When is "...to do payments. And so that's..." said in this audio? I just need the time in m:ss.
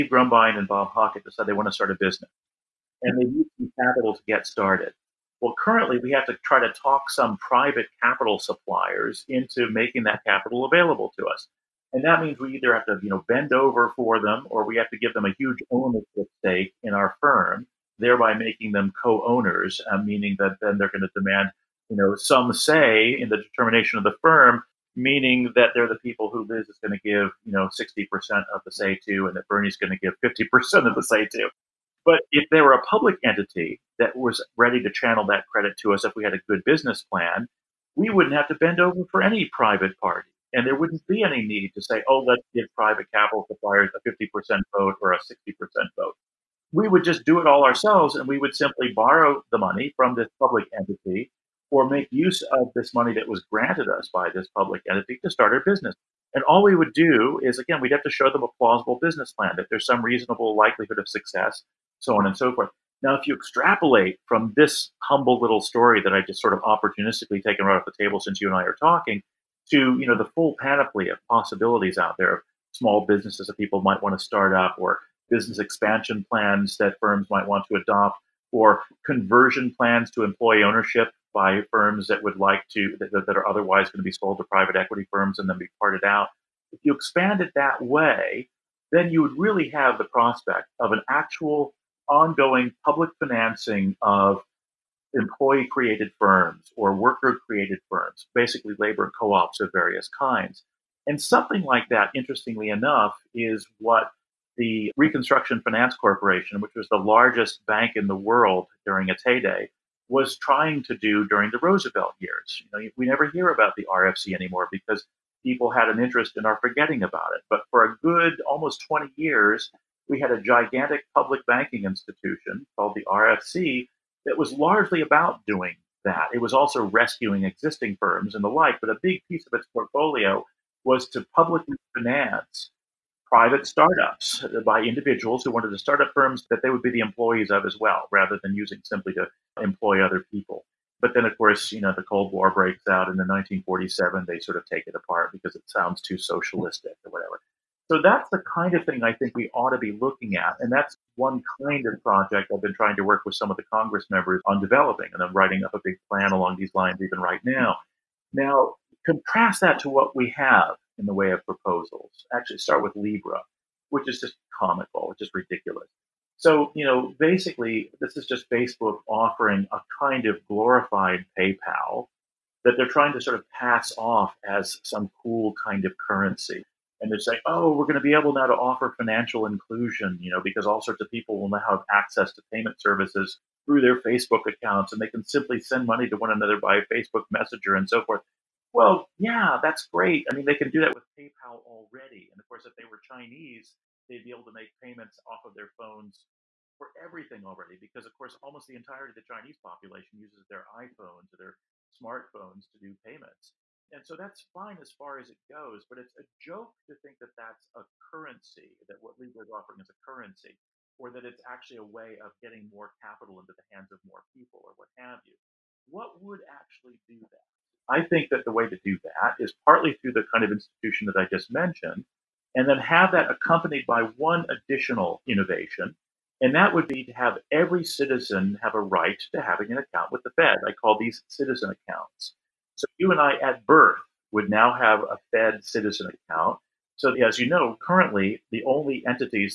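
3:22.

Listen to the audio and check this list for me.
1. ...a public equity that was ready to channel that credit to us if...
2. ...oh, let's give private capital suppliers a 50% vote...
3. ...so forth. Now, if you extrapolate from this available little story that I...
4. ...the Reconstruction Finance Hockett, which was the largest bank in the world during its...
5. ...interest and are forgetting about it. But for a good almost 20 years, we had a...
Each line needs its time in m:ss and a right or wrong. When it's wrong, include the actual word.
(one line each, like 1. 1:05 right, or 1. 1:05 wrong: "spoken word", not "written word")
1. 0:32 wrong: "entity", not "equity"
2. 0:42 right
3. 1:02 wrong: "humble", not "available"
4. 1:44 wrong: "Corporation", not "Hockett"
5. 1:55 right.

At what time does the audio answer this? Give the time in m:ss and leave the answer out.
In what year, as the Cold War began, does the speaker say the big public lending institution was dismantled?
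2:23.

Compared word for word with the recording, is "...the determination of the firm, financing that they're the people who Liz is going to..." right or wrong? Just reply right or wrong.
wrong.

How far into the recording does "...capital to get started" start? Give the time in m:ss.
0:03.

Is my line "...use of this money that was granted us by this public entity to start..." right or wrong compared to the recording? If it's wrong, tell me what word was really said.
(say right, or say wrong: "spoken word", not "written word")
right.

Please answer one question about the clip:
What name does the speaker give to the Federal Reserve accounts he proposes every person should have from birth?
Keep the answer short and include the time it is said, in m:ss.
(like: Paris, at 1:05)
citizen accounts, at 3:51.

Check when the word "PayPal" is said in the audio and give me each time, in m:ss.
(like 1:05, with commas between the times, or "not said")
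2:51, 3:11.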